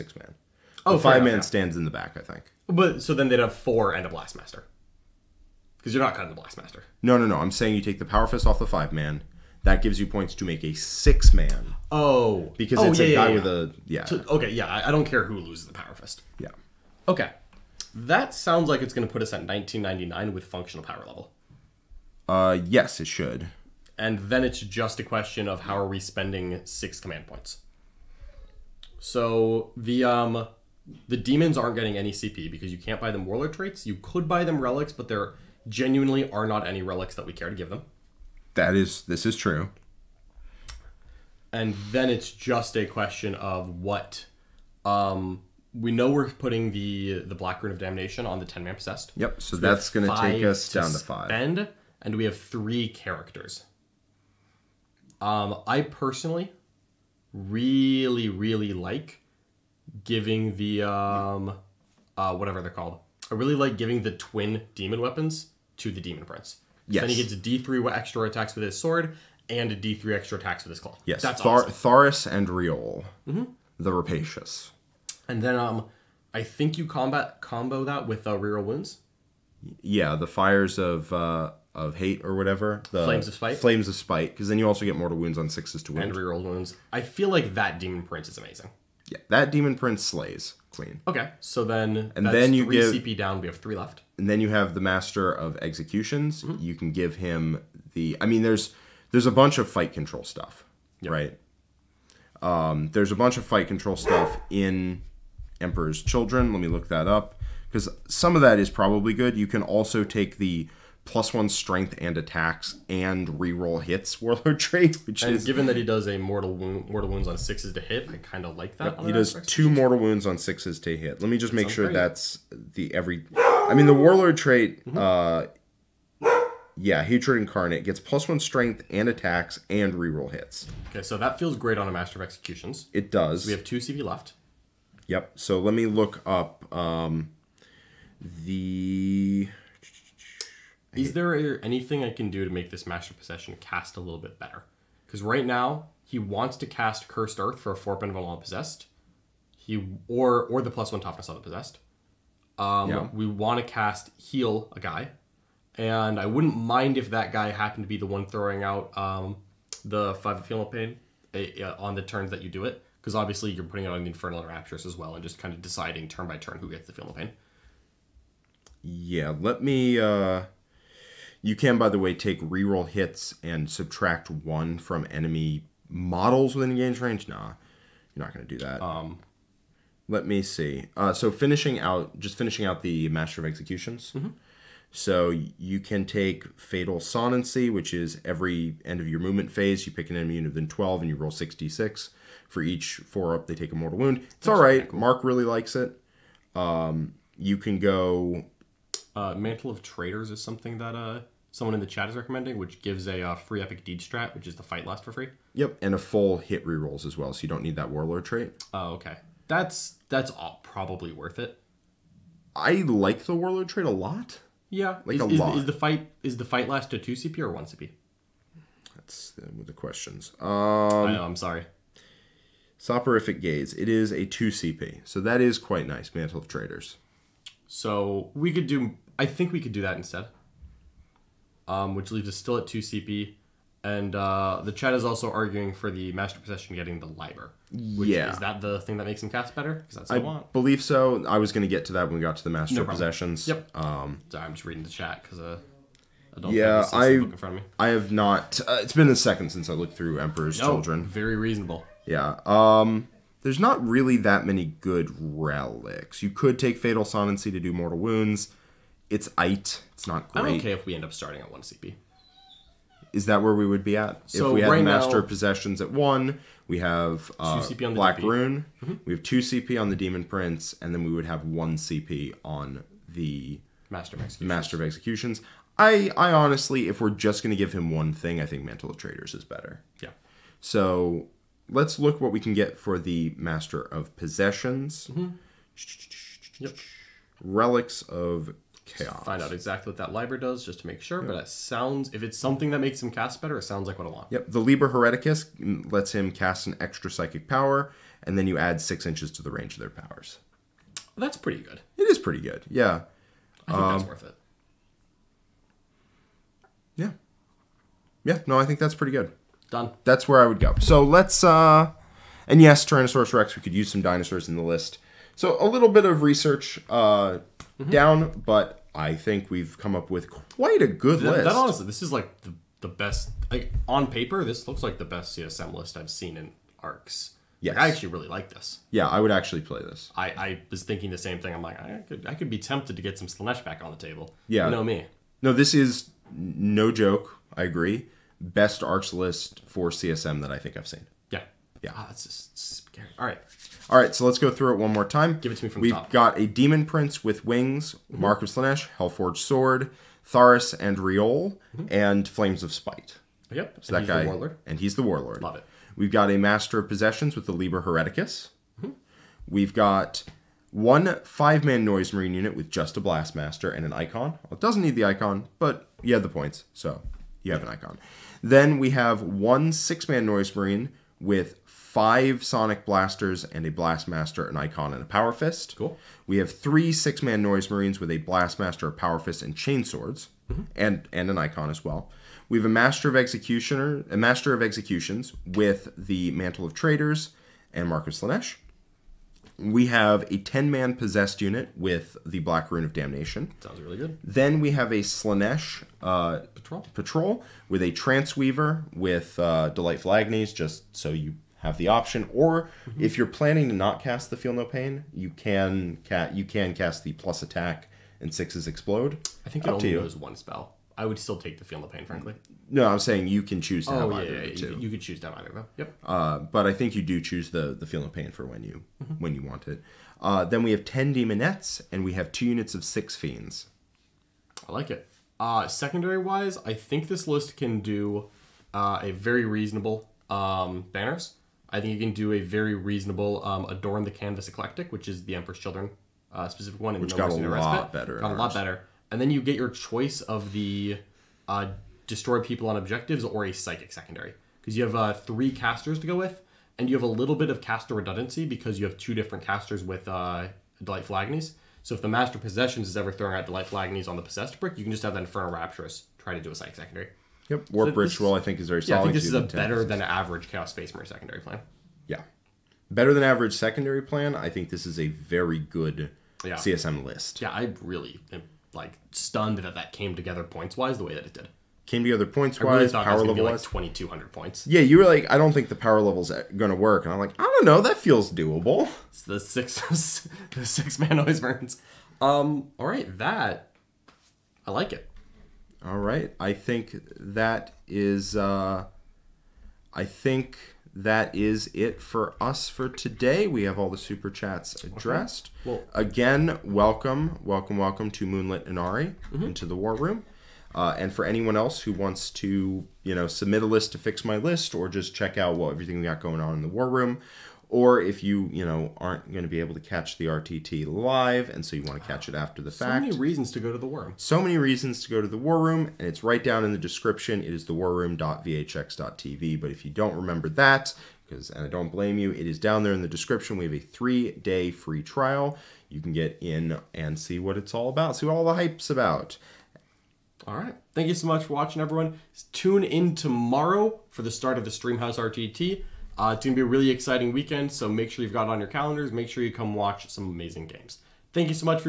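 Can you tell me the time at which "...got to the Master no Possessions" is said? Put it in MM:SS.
04:02.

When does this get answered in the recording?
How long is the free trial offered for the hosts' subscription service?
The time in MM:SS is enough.
08:43.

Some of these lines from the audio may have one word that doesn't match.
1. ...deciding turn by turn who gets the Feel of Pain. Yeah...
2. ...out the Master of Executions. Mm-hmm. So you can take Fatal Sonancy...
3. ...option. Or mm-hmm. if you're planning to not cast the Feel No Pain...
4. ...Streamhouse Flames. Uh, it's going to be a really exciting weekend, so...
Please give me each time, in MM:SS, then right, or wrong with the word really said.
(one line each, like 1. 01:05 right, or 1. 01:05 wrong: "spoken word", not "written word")
1. 02:45 right
2. 03:02 right
3. 06:41 right
4. 08:54 wrong: "RTT", not "Flames".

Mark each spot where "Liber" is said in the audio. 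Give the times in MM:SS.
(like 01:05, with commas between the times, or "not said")
03:57, 04:54, 05:57.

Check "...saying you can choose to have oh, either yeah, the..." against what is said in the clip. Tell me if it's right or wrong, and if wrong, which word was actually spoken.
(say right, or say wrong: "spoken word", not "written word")
right.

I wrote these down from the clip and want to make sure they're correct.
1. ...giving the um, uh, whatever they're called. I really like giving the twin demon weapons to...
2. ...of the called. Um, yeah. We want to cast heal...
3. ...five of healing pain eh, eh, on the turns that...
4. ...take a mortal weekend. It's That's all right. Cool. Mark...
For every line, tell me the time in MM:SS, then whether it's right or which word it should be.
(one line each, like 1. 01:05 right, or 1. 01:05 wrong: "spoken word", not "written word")
1. 01:00 right
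2. 02:31 wrong: "possessed", not "called"
3. 02:40 right
4. 03:13 wrong: "wound", not "weekend".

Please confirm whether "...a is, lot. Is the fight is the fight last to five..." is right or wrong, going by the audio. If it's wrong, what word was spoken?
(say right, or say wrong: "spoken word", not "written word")
wrong: "two", not "five".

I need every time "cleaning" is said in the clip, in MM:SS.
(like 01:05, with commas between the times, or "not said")
not said.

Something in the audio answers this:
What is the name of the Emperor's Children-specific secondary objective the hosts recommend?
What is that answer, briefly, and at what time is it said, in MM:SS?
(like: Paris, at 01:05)
Adorn the Canvas Eclectic, at 07:13.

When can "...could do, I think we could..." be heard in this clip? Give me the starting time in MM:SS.
03:48.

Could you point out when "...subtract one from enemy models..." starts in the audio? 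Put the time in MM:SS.
02:53.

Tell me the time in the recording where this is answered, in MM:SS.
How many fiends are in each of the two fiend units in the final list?
07:02.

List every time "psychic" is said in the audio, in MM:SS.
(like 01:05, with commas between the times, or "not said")
04:57, 07:23, 07:36.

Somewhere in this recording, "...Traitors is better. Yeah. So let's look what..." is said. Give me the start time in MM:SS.
04:38.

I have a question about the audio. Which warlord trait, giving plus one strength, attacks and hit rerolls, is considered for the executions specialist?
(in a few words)
Hatred Incarnate.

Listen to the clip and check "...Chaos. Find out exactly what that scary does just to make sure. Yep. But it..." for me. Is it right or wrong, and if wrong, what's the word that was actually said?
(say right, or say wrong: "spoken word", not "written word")
wrong: "library", not "scary".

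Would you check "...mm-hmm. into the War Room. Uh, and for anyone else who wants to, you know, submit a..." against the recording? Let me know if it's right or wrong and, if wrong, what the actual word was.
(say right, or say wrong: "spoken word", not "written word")
right.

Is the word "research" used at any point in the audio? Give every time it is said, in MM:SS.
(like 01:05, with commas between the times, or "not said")
05:16.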